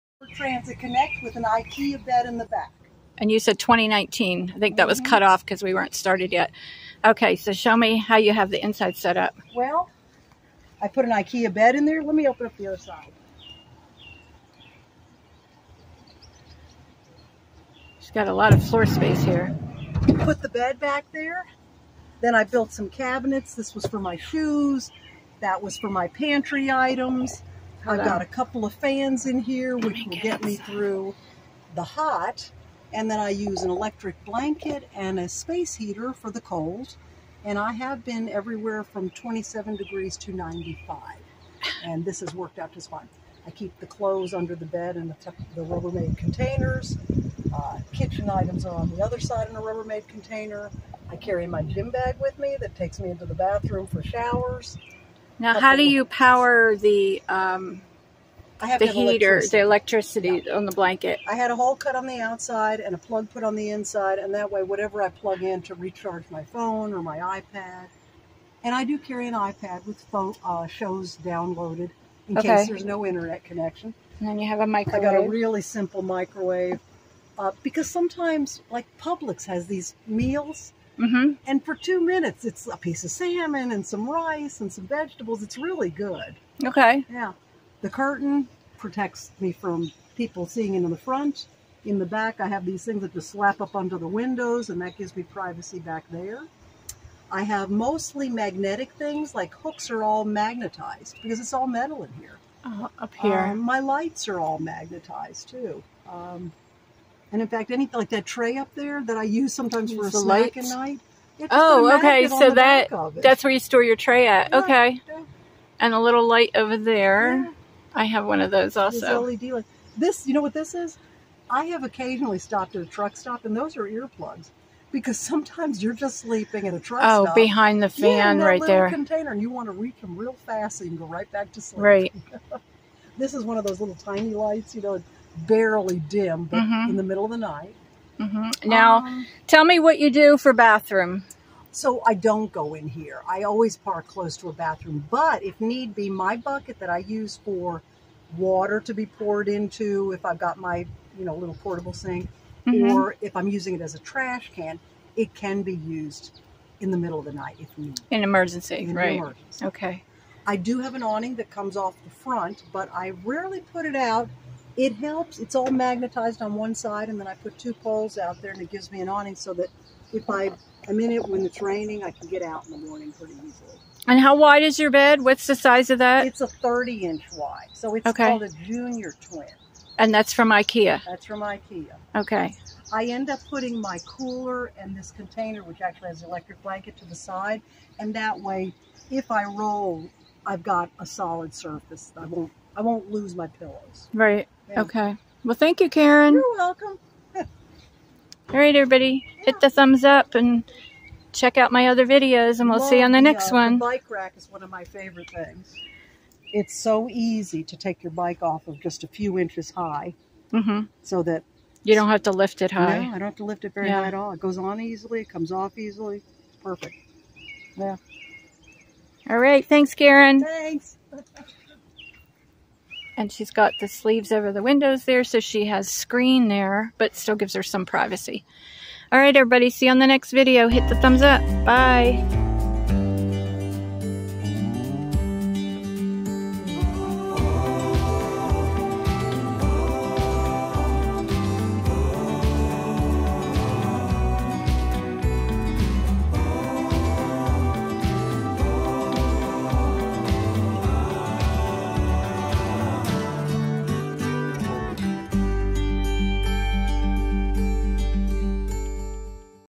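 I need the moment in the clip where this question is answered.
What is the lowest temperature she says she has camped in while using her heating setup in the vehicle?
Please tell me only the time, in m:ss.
0:39.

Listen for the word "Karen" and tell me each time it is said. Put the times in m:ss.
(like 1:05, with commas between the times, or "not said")
3:15, 3:39.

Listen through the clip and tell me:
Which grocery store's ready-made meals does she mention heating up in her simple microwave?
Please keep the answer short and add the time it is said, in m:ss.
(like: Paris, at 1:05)
Publix, at 1:18.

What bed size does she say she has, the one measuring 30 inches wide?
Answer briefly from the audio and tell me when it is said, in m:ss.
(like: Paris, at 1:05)
junior twin, at 2:58.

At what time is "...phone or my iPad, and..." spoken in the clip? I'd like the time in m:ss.
1:06.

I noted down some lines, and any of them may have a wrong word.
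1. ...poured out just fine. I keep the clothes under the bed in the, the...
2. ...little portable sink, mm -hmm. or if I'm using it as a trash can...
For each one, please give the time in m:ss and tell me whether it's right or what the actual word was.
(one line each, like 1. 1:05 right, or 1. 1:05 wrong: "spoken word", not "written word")
1. 0:42 wrong: "worked", not "poured"
2. 2:31 right.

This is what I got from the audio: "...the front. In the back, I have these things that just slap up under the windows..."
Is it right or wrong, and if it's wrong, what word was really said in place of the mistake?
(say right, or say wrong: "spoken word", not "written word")
right.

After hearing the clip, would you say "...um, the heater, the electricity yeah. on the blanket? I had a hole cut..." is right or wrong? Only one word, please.
right.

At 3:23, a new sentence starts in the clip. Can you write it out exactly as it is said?
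The bike rack is one of my favorite things.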